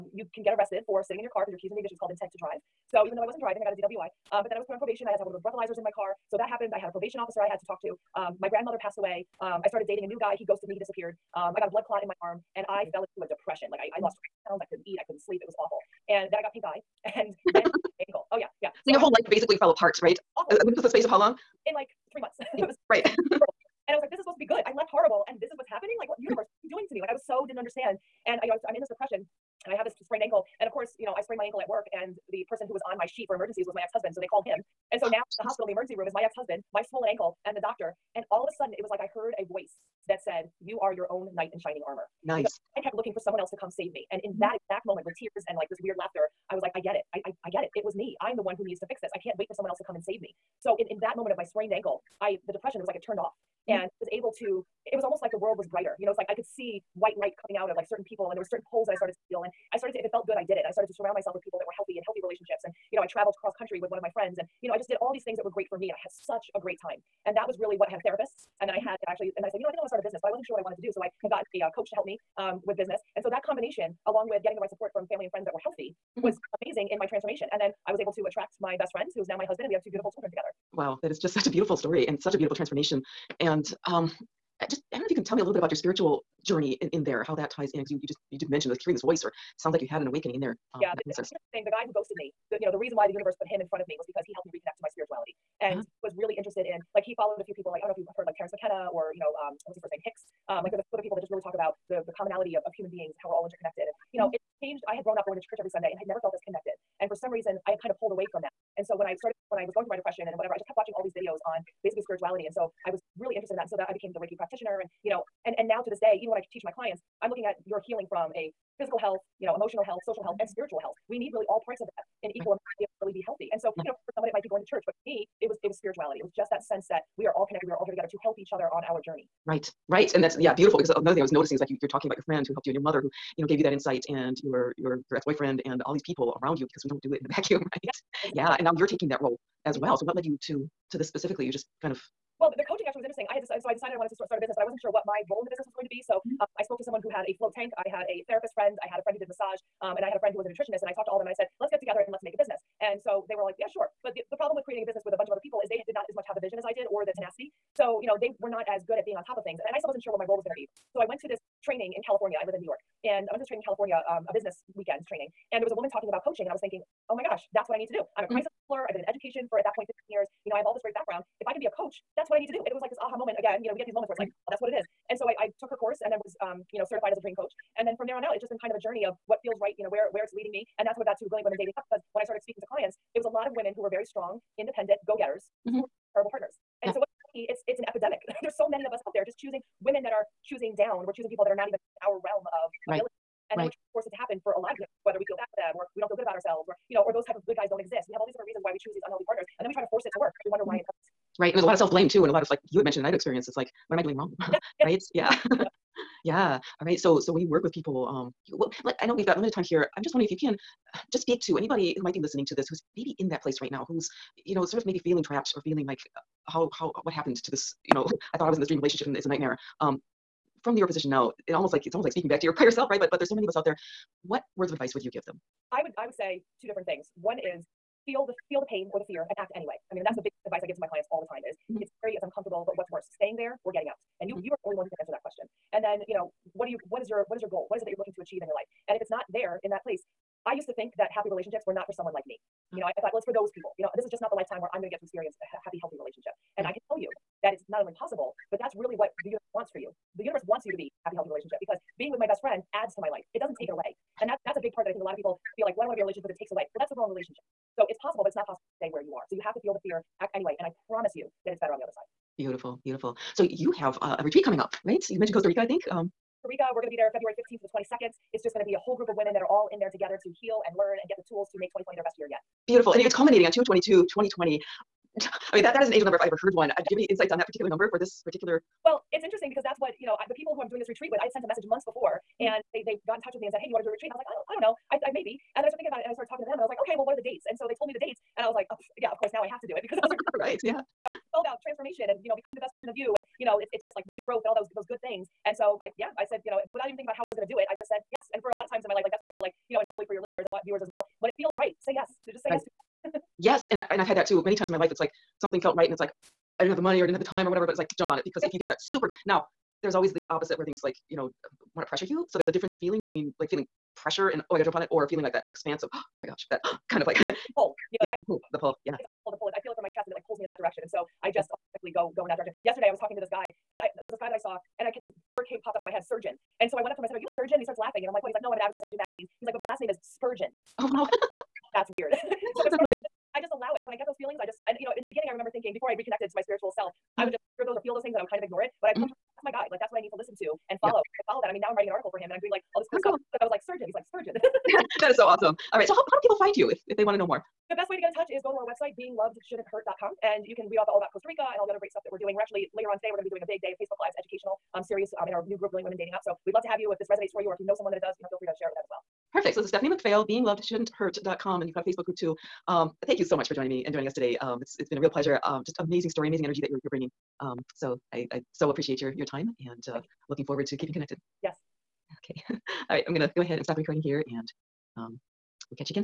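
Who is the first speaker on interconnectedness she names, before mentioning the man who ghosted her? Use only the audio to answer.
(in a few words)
Terence McKenna.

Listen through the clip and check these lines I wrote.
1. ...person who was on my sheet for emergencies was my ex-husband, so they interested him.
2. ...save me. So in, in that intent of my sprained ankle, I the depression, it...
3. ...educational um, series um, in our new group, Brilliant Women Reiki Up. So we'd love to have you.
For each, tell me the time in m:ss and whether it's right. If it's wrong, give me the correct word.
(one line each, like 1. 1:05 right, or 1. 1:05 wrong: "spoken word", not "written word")
1. 0:32 wrong: "called", not "interested"
2. 0:50 wrong: "moment", not "intent"
3. 5:54 wrong: "Dating", not "Reiki".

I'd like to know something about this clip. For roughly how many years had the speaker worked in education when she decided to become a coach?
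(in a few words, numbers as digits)
15.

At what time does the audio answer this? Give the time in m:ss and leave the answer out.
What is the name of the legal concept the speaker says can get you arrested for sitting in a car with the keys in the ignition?
0:02.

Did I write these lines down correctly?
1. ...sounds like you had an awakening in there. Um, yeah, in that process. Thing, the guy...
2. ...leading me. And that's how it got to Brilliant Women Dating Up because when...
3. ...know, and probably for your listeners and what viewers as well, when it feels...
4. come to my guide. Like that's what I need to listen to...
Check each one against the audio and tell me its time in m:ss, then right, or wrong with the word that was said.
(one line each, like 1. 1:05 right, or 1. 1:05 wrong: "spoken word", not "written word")
1. 1:29 right
2. 3:00 right
3. 4:59 right
4. 5:39 right.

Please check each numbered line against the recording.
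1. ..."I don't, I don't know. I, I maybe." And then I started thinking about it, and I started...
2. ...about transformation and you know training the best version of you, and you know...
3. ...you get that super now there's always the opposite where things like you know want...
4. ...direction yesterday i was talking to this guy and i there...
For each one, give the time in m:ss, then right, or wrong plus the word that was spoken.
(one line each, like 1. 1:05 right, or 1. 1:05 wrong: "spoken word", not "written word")
1. 4:44 right
2. 4:51 wrong: "becoming", not "training"
3. 5:08 right
4. 5:22 right.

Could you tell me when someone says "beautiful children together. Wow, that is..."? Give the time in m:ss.
1:19.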